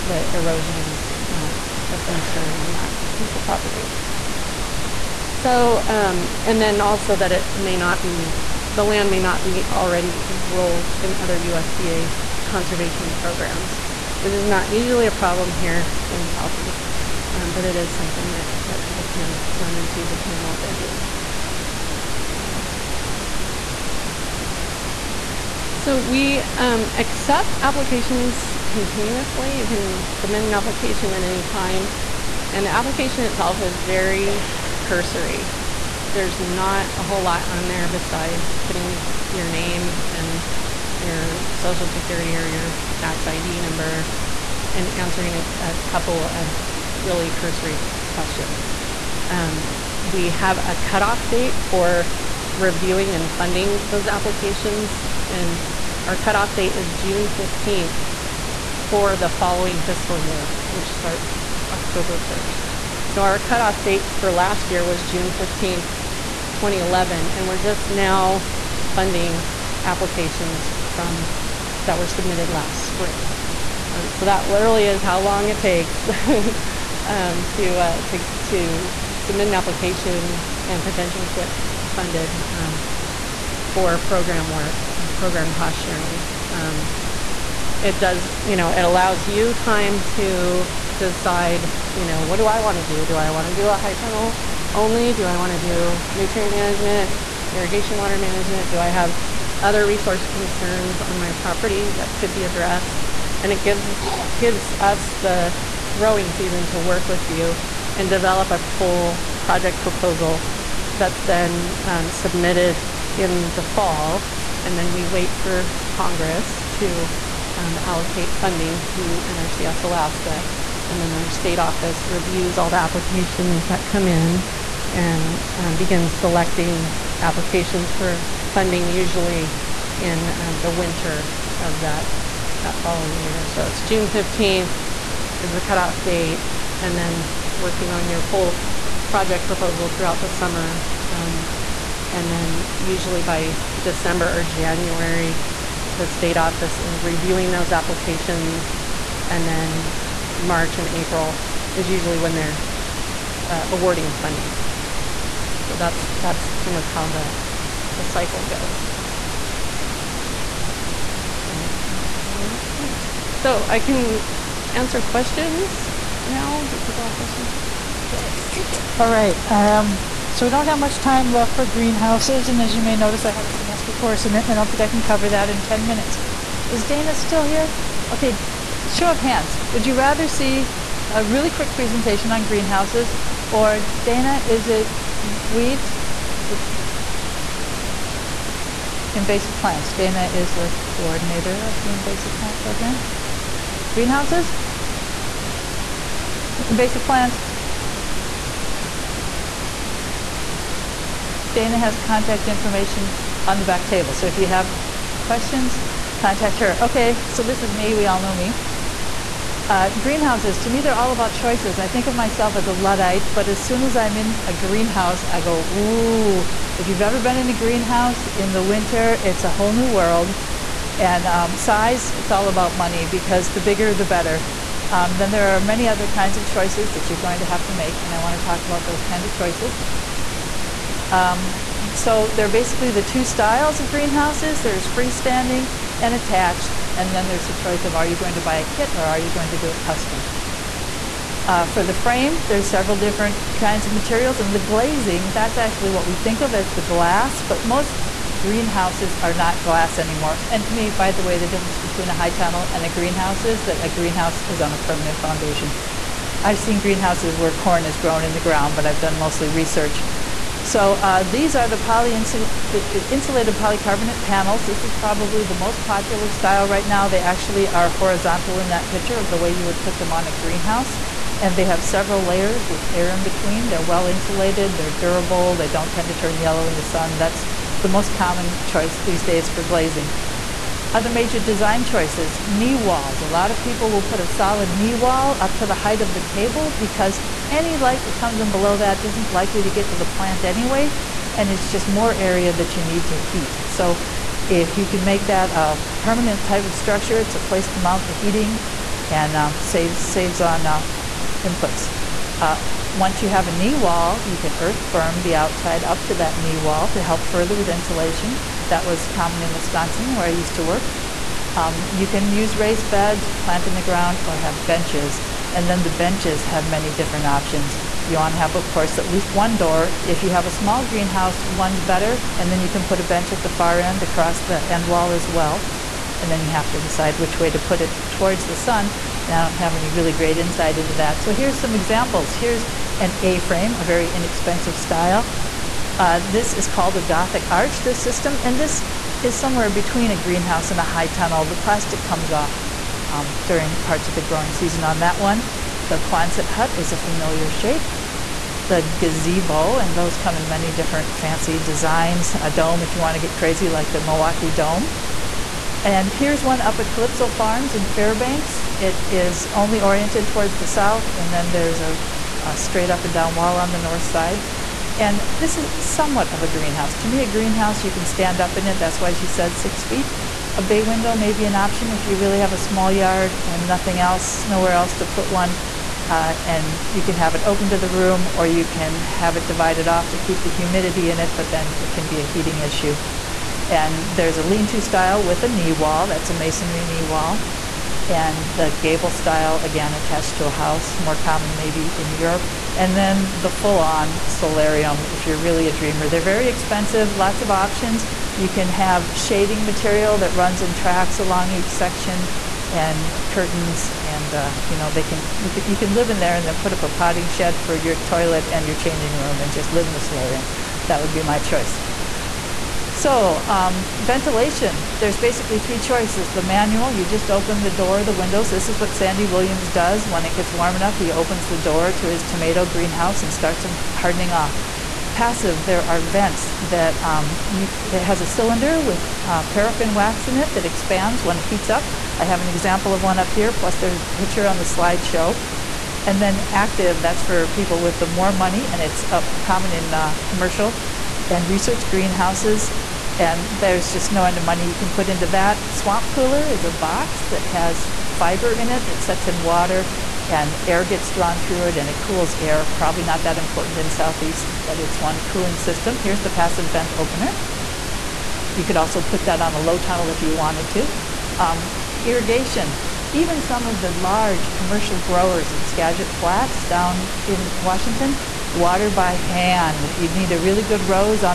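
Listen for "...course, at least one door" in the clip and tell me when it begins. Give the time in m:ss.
5:18.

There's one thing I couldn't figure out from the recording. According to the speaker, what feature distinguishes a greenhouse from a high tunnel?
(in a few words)
A permanent foundation.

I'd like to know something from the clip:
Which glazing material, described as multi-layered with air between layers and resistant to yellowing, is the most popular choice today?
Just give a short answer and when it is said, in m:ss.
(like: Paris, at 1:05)
Insulated polycarbonate panels, at 4:22.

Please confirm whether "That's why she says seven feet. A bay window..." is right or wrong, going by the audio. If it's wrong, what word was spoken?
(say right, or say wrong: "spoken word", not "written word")
wrong: "six", not "seven".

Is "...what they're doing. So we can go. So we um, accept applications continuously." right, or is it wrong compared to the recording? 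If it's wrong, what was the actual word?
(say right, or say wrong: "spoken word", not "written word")
right.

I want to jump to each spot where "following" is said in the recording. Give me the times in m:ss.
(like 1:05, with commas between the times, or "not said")
0:59, 2:12.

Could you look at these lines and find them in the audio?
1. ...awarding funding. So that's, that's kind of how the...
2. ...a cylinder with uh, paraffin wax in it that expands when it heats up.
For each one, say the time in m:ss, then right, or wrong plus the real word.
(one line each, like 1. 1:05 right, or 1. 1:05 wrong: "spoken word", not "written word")
1. 2:33 right
2. 7:08 right.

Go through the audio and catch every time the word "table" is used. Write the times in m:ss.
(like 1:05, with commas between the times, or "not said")
3:23, 4:46.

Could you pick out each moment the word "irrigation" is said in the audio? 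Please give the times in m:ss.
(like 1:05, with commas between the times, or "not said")
1:37, 7:42.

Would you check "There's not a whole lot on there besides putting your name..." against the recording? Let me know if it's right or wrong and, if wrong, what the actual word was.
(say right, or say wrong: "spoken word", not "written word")
right.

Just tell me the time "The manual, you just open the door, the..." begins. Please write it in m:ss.
6:56.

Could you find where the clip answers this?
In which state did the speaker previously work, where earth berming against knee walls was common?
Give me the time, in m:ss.
5:09.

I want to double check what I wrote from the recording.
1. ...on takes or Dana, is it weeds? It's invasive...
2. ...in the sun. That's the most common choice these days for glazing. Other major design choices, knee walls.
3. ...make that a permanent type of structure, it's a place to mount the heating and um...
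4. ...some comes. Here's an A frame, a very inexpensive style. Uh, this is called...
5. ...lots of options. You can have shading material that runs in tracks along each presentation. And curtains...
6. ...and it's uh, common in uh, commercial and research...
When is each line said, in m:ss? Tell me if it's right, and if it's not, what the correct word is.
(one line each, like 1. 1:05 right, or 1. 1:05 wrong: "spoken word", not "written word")
1. 3:02 wrong: "greenhouses", not "takes"
2. 4:36 right
3. 4:55 right
4. 5:31 wrong: "examples", not "comes"
5. 6:37 wrong: "section", not "presentation"
6. 7:18 right.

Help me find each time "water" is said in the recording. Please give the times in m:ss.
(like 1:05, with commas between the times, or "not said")
1:37, 7:29, 7:48.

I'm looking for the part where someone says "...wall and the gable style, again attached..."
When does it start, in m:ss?
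6:27.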